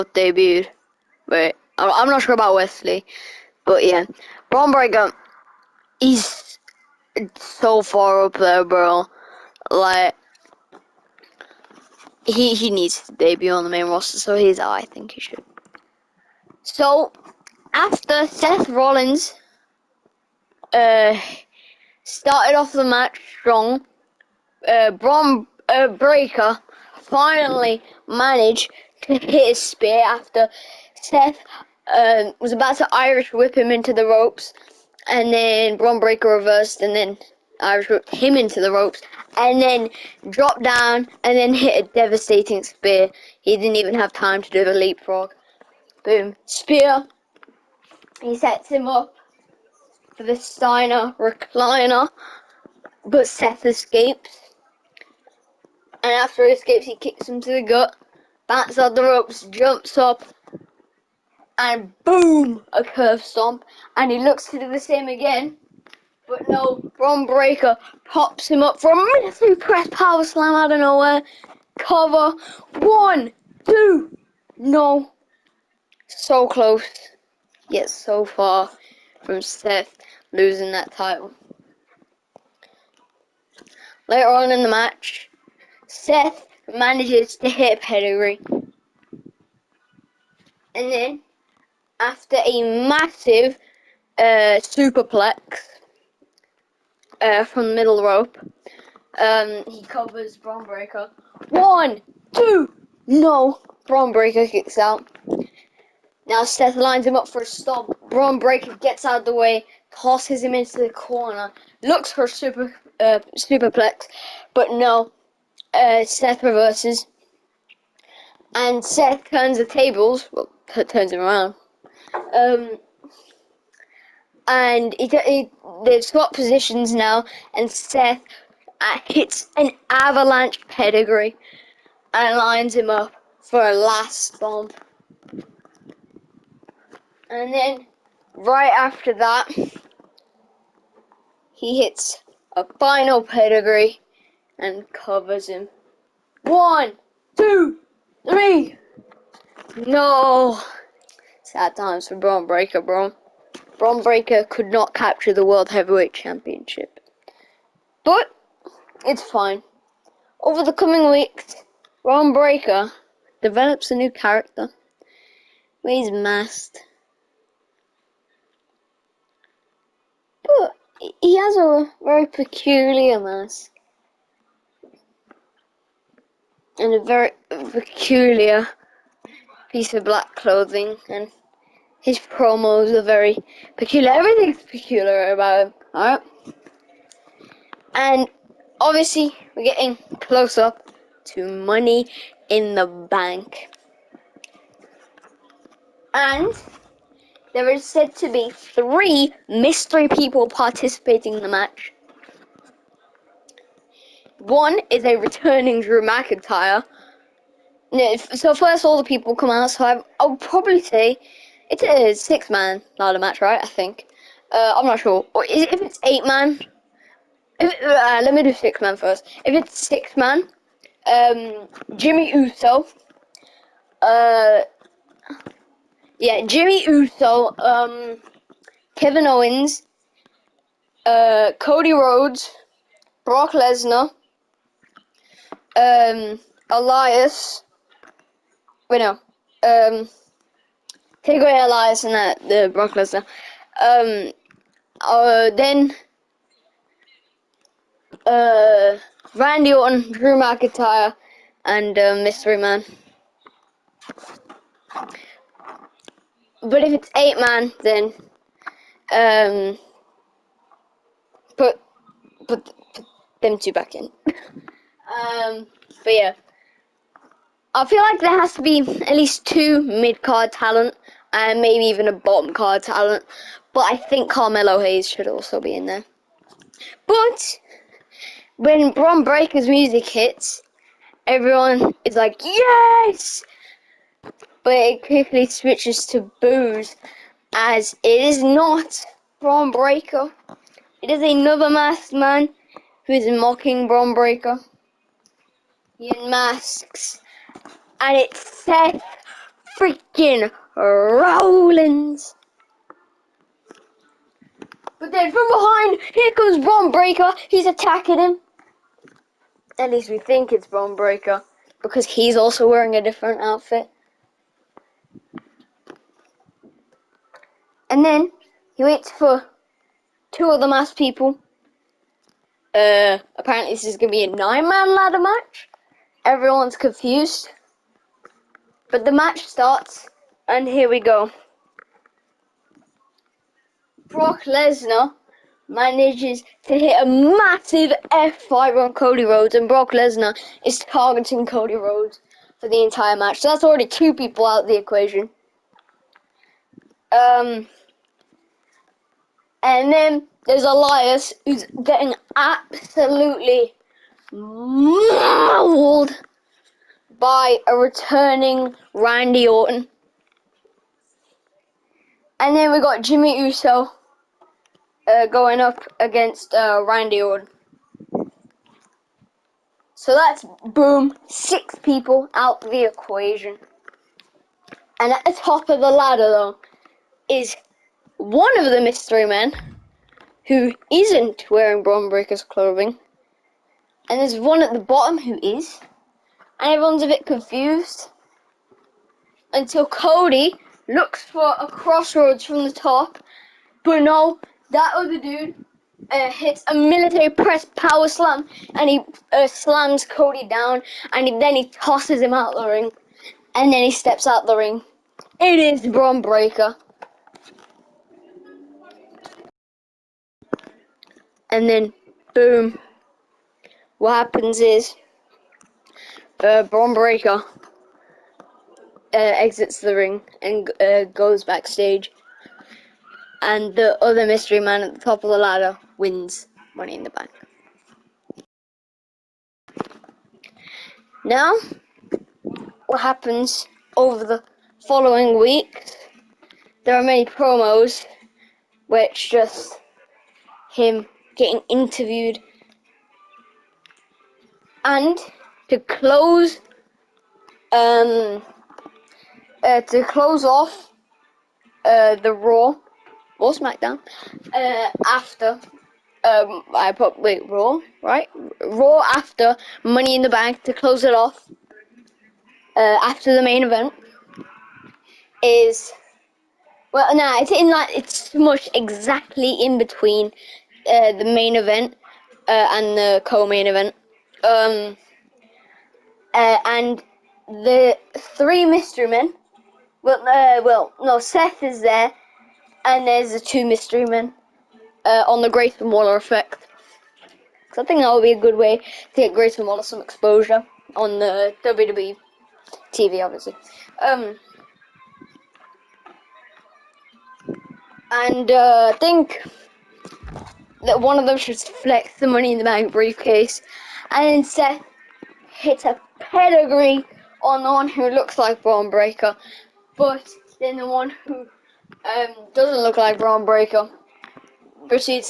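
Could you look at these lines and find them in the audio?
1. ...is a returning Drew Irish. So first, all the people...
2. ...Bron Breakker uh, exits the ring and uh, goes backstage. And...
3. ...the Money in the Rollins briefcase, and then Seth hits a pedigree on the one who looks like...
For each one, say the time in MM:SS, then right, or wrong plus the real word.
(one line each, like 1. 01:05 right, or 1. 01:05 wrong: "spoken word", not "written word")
1. 03:24 wrong: "McIntyre", not "Irish"
2. 06:56 right
3. 08:22 wrong: "Bank", not "Rollins".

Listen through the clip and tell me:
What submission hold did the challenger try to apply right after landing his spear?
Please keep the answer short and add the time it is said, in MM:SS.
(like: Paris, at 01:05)
Steiner recliner, at 00:50.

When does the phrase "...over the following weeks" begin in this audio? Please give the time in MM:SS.
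07:13.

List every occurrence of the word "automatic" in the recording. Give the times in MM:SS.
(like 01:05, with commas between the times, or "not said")
not said.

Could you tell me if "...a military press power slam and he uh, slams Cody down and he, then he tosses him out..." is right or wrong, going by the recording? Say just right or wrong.
right.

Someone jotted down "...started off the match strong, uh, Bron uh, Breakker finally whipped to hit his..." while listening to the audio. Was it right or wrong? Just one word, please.
wrong.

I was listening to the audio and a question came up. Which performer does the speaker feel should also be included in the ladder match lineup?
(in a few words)
Carmelo Hayes.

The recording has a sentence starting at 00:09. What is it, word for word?
Like, he he needs to debut on the main roster, so he's I think he should.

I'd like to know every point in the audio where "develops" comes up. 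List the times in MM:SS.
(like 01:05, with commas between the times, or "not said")
02:43.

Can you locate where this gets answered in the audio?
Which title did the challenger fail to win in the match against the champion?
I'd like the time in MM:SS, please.
02:35.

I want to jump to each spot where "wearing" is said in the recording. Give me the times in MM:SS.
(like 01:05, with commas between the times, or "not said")
05:12, 06:21.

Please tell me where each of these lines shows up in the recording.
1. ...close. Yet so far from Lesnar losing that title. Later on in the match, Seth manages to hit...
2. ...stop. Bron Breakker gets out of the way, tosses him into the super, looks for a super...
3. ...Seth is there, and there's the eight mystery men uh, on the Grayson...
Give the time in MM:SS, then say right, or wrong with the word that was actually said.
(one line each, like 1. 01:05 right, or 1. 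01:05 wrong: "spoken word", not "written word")
1. 01:16 wrong: "Seth", not "Lesnar"
2. 01:47 wrong: "corner", not "super"
3. 08:01 wrong: "two", not "eight".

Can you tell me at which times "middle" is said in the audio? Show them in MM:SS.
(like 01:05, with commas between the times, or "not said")
01:37.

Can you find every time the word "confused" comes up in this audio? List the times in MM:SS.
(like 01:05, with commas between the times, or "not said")
05:26, 06:27.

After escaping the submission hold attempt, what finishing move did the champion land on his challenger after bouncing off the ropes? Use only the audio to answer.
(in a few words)
Curb Stomp.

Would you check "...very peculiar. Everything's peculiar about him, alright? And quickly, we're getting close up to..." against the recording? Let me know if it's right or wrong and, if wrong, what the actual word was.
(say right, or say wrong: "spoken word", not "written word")
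wrong: "obviously", not "quickly".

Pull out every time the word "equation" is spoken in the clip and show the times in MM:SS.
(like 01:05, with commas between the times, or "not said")
05:44, 06:12.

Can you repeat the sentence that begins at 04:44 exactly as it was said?
But it quickly switches to boos as it is not Bron Breakker.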